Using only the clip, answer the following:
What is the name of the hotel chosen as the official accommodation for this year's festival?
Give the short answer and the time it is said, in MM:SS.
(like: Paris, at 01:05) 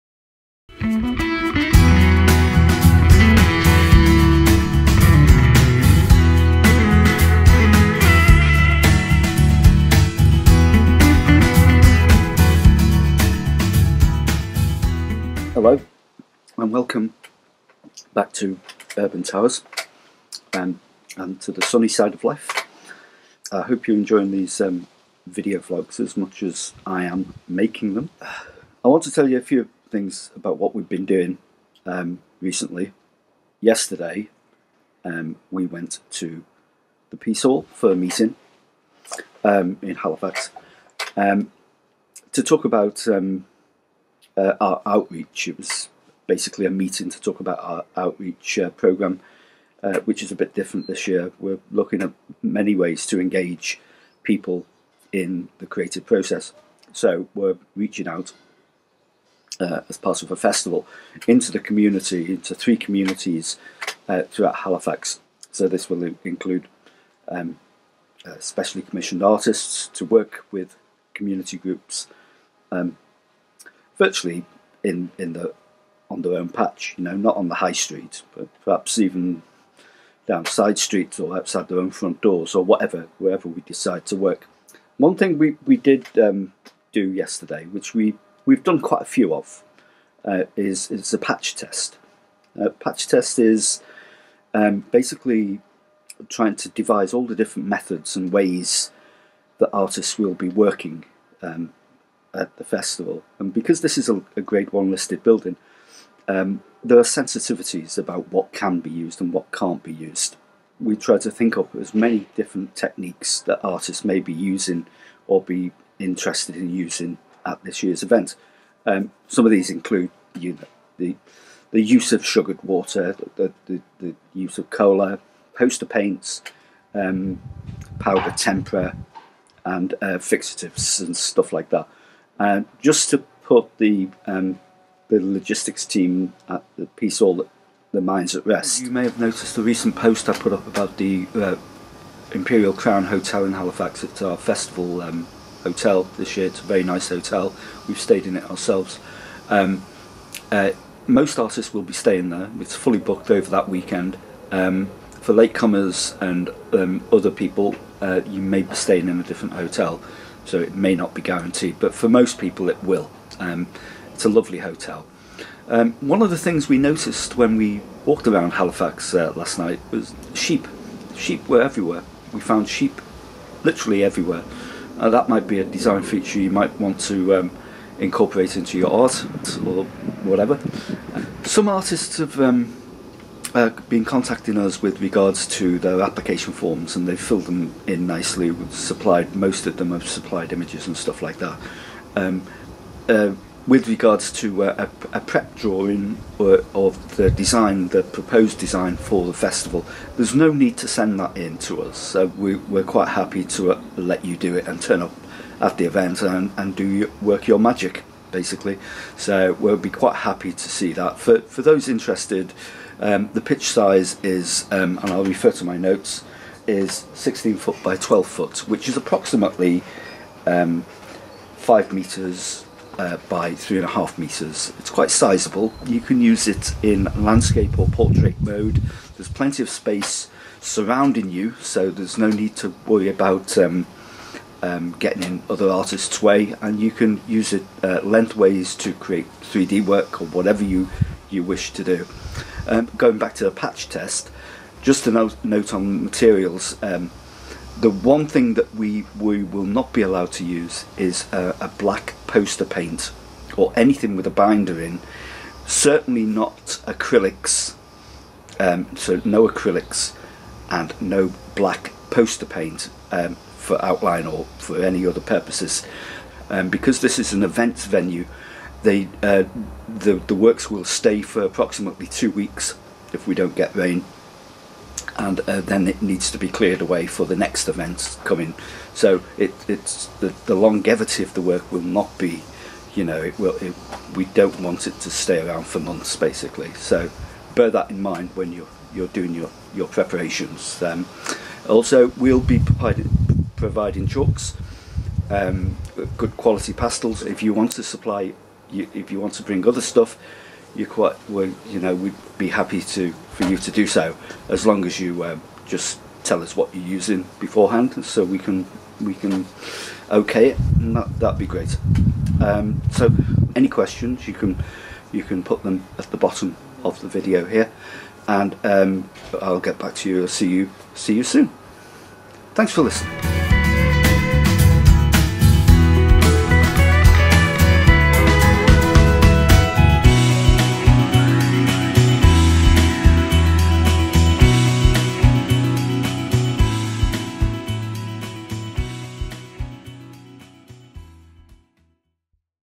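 Imperial Crown Hotel, at 02:22.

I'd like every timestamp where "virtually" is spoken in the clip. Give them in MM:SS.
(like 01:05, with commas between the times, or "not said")
01:13.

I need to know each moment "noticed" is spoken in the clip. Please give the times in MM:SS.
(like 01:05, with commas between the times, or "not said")
02:19, 02:46.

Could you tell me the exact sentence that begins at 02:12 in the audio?
Uh, just to put the um, the logistics team at the Piece Hall the minds at Rest.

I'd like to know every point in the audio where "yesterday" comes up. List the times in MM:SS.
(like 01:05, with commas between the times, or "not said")
00:33, 01:27.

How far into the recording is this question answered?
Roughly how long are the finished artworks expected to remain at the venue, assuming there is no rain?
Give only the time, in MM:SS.
04:32.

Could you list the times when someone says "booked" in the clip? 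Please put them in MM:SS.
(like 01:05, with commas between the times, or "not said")
02:32.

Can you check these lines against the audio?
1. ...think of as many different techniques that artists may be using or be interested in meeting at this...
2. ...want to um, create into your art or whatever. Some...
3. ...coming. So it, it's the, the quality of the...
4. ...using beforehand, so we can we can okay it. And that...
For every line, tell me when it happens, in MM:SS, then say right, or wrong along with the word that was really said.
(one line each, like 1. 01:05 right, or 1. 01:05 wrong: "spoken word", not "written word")
1. 01:51 wrong: "using", not "meeting"
2. 02:56 wrong: "incorporate", not "create"
3. 04:38 wrong: "longevity", not "quality"
4. 05:06 right.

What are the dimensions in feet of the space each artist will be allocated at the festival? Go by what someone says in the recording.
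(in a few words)
16 foot by 12 foot.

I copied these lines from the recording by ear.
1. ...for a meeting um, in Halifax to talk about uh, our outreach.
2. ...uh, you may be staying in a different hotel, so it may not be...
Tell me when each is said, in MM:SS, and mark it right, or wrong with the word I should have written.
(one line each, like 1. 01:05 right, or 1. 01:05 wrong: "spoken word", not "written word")
1. 00:37 right
2. 02:37 right.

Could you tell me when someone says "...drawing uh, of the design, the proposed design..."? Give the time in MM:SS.
03:15.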